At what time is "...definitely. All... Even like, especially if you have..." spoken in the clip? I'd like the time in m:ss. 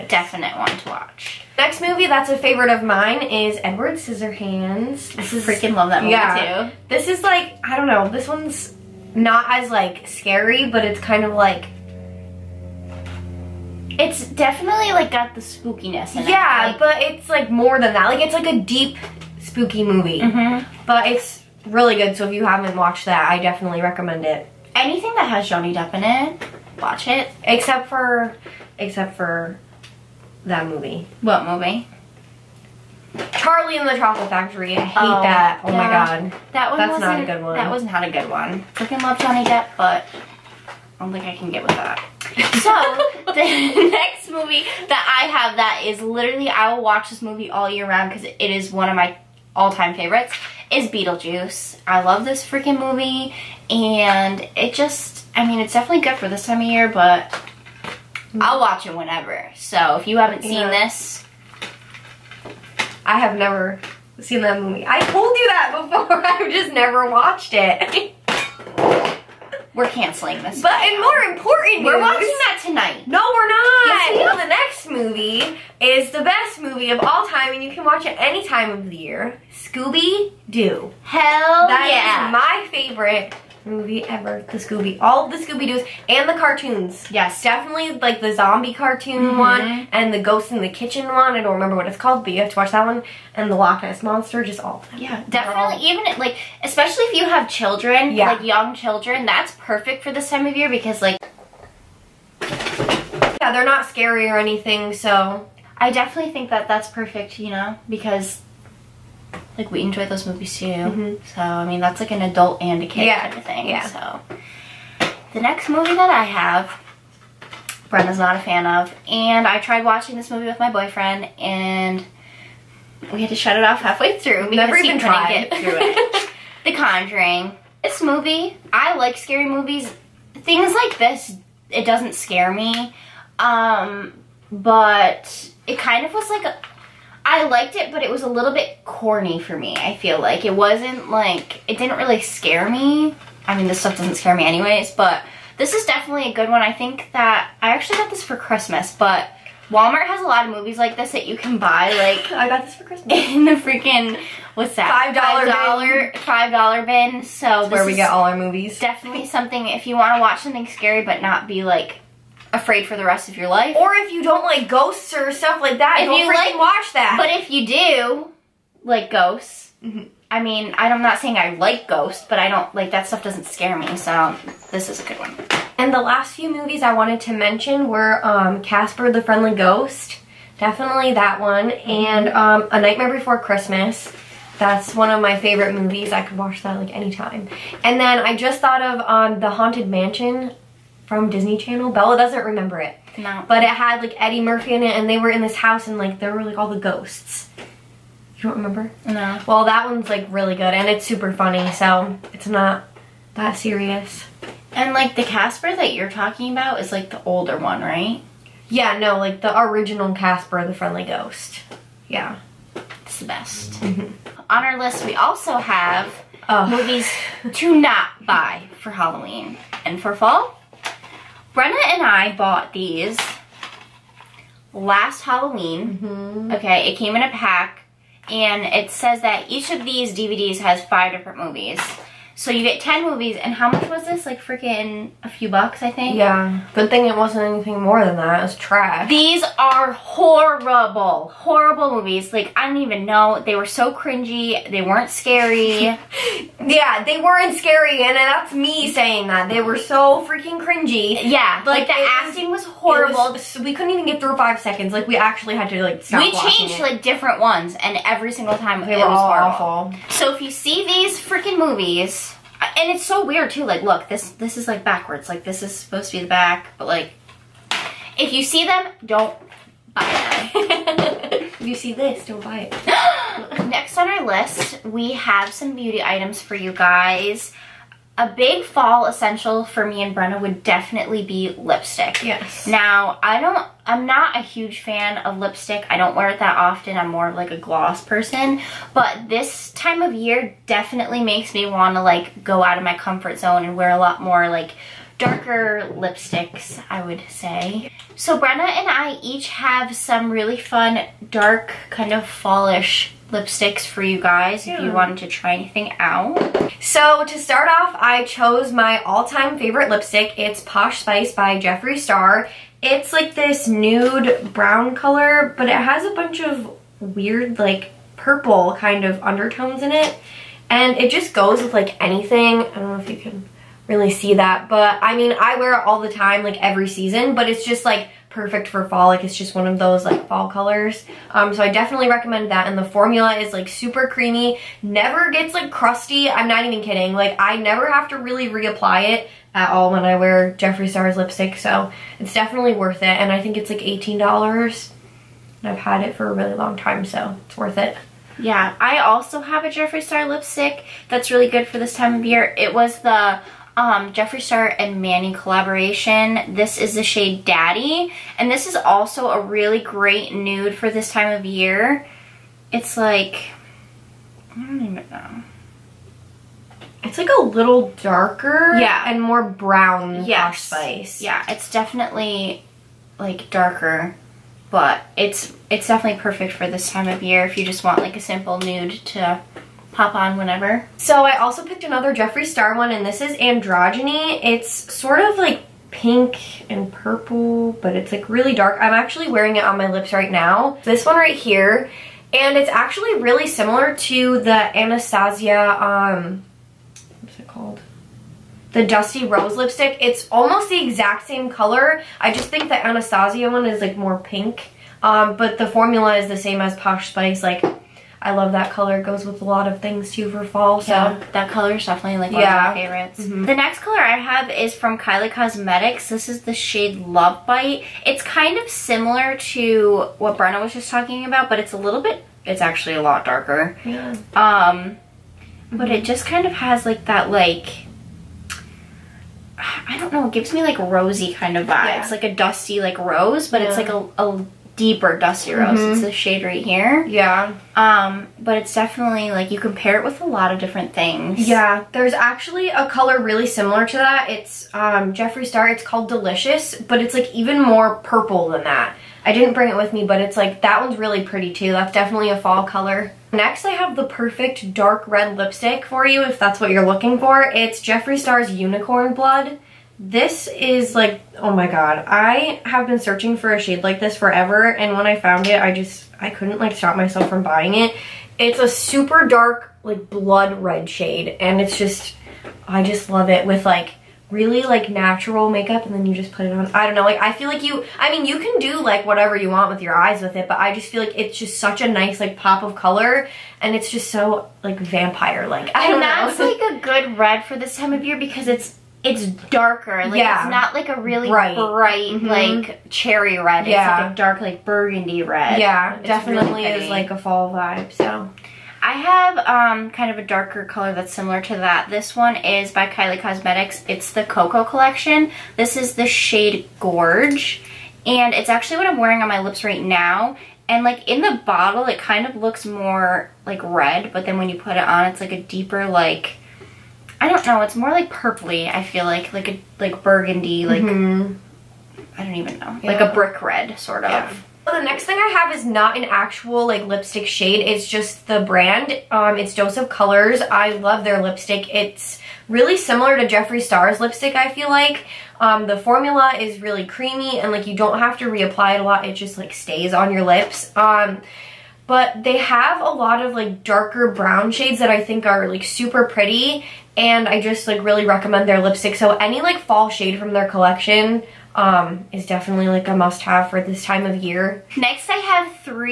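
1:35.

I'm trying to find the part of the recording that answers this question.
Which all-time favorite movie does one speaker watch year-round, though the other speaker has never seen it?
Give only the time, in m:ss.
0:50.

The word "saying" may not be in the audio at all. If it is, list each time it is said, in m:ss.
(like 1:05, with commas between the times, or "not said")
2:51, 4:08.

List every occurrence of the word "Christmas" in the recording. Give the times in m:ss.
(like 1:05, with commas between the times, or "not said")
2:28, 2:32, 3:03.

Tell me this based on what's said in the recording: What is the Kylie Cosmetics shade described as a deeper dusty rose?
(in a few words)
Love Bite.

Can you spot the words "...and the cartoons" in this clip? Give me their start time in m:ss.
1:26.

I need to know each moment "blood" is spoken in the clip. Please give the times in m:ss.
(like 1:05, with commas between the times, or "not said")
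7:39, 7:50.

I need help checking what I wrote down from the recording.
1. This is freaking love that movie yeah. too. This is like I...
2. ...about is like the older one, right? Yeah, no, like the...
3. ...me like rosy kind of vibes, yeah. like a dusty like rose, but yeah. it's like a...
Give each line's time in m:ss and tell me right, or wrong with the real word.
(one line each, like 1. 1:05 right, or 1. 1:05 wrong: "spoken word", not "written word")
1. 0:05 right
2. 3:26 right
3. 7:10 right.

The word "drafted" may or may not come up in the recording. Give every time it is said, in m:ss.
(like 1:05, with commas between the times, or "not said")
not said.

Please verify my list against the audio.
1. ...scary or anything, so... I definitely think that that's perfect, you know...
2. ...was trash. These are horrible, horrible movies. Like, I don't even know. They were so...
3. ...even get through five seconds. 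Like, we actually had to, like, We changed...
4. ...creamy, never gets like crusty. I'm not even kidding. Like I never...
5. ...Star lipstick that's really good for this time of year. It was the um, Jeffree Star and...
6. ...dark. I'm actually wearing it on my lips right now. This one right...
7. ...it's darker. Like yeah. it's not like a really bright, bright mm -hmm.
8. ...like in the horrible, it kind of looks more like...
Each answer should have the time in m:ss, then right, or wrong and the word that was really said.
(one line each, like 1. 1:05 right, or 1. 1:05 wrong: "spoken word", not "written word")
1. 1:43 right
2. 3:58 right
3. 4:13 right
4. 5:34 right
5. 5:50 right
6. 6:28 right
7. 8:09 right
8. 8:30 wrong: "bottle", not "horrible".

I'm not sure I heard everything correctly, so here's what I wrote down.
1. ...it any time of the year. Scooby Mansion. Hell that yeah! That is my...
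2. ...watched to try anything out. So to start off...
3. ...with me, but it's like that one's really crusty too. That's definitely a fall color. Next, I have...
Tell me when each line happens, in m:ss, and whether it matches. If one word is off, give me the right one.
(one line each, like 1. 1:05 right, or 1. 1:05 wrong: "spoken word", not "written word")
1. 1:18 wrong: "Doo", not "Mansion"
2. 5:04 wrong: "wanted", not "watched"
3. 7:29 wrong: "pretty", not "crusty".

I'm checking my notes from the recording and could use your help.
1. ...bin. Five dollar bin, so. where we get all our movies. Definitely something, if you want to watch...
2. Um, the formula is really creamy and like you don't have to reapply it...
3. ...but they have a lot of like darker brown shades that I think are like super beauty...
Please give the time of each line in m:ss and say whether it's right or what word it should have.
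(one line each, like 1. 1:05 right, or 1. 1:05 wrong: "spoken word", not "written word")
1. 2:36 right
2. 8:55 right
3. 9:01 wrong: "pretty", not "beauty".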